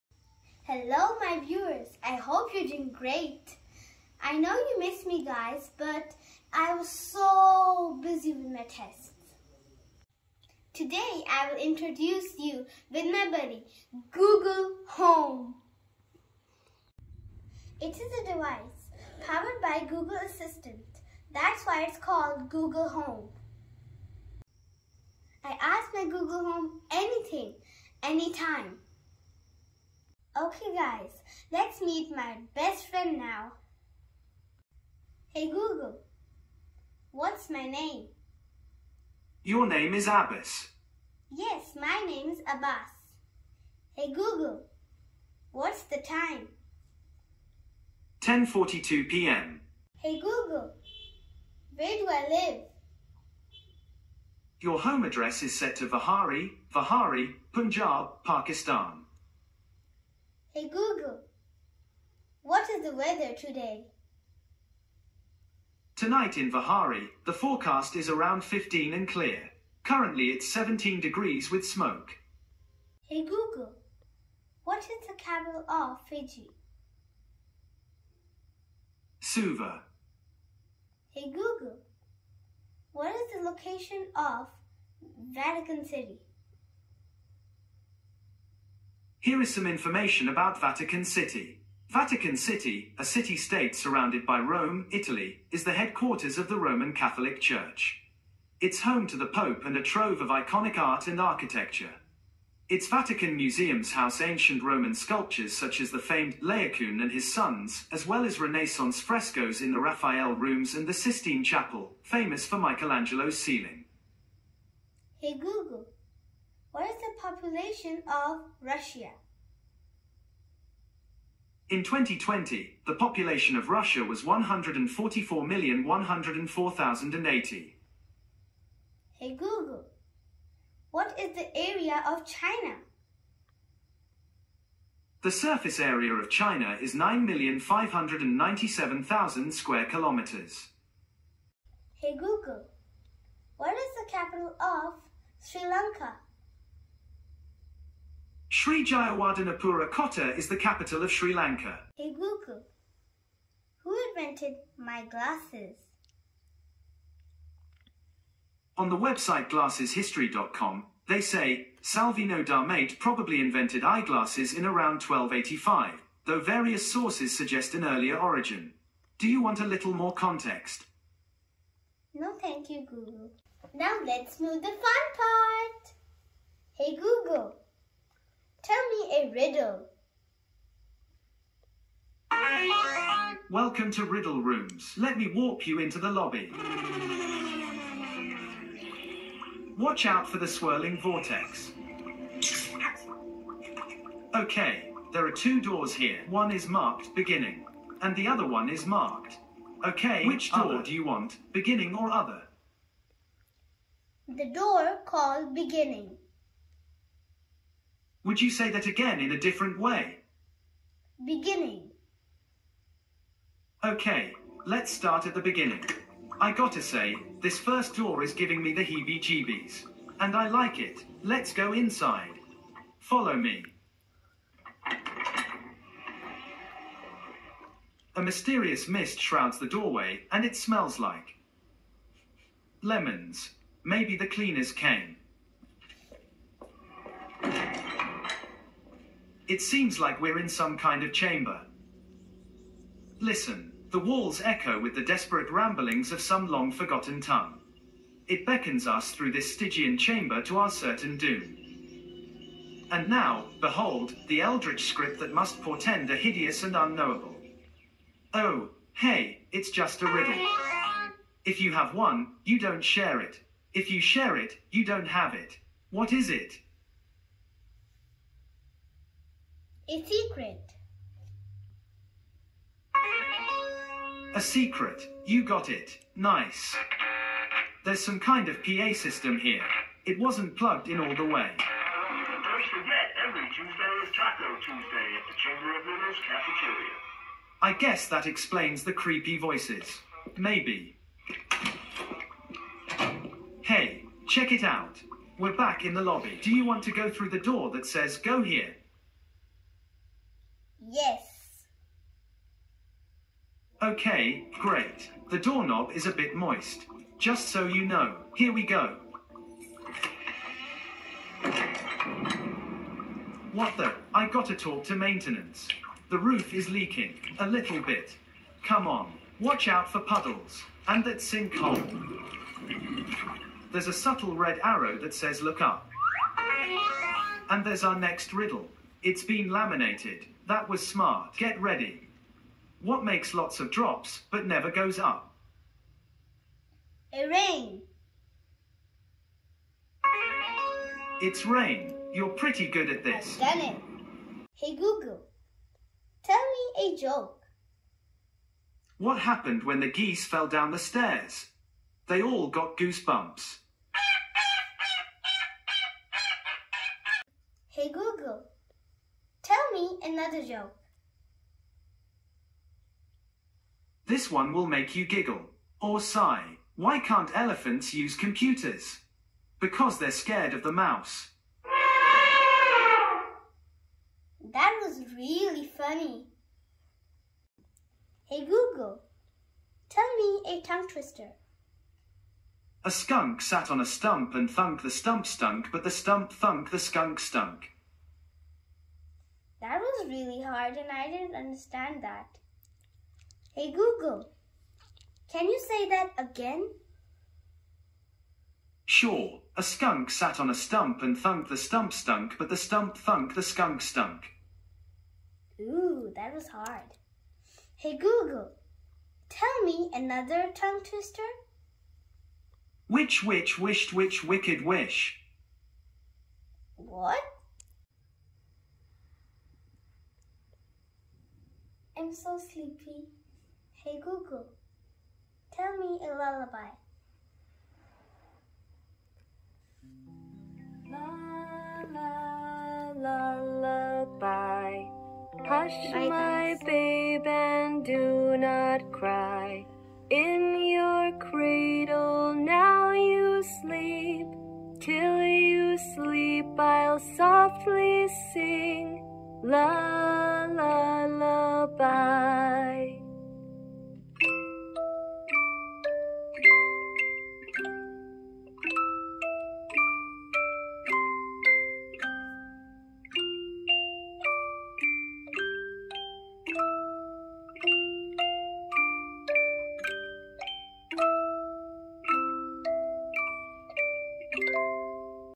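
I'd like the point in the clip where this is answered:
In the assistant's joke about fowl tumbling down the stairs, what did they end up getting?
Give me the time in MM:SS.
05:52.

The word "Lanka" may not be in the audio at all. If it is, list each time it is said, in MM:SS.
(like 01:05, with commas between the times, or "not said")
02:25, 02:31.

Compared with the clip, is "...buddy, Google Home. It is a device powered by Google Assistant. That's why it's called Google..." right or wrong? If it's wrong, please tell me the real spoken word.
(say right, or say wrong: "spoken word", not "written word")
right.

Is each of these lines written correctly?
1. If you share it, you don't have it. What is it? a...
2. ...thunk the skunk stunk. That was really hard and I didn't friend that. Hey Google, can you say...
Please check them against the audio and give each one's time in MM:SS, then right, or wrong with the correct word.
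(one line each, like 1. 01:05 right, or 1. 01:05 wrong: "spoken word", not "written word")
1. 04:23 right
2. 06:26 wrong: "understand", not "friend".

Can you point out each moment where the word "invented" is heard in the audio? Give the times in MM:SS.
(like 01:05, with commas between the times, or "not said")
02:34, 02:43.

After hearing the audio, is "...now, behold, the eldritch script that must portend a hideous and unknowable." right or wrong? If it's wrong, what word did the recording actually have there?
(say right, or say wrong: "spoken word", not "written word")
right.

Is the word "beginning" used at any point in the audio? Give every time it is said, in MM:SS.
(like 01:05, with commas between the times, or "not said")
03:17, 03:21, 03:25, 03:31, 03:35.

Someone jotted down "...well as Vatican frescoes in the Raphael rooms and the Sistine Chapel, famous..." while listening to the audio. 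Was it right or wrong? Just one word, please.
wrong.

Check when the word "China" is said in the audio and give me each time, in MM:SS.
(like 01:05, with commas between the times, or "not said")
02:12, 02:16.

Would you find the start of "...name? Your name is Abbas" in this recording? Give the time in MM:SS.
00:37.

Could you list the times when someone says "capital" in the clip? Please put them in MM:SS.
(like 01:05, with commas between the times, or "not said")
01:15, 02:24, 02:30.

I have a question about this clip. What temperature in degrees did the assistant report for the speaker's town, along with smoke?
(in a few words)
17.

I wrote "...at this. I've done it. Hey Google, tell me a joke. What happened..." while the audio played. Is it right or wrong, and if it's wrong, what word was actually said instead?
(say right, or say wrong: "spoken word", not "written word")
right.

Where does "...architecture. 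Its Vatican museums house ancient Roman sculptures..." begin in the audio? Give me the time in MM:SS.
01:41.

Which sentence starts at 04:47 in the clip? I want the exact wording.
I guess that explains the creepy voices.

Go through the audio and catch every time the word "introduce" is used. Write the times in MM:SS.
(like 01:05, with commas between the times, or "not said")
00:11.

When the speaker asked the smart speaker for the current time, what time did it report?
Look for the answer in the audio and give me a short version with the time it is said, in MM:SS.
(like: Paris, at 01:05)
10:42 p.m., at 00:48.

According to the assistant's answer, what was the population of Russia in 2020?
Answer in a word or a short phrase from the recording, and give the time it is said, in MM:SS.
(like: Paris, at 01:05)
144,104,080, at 02:04.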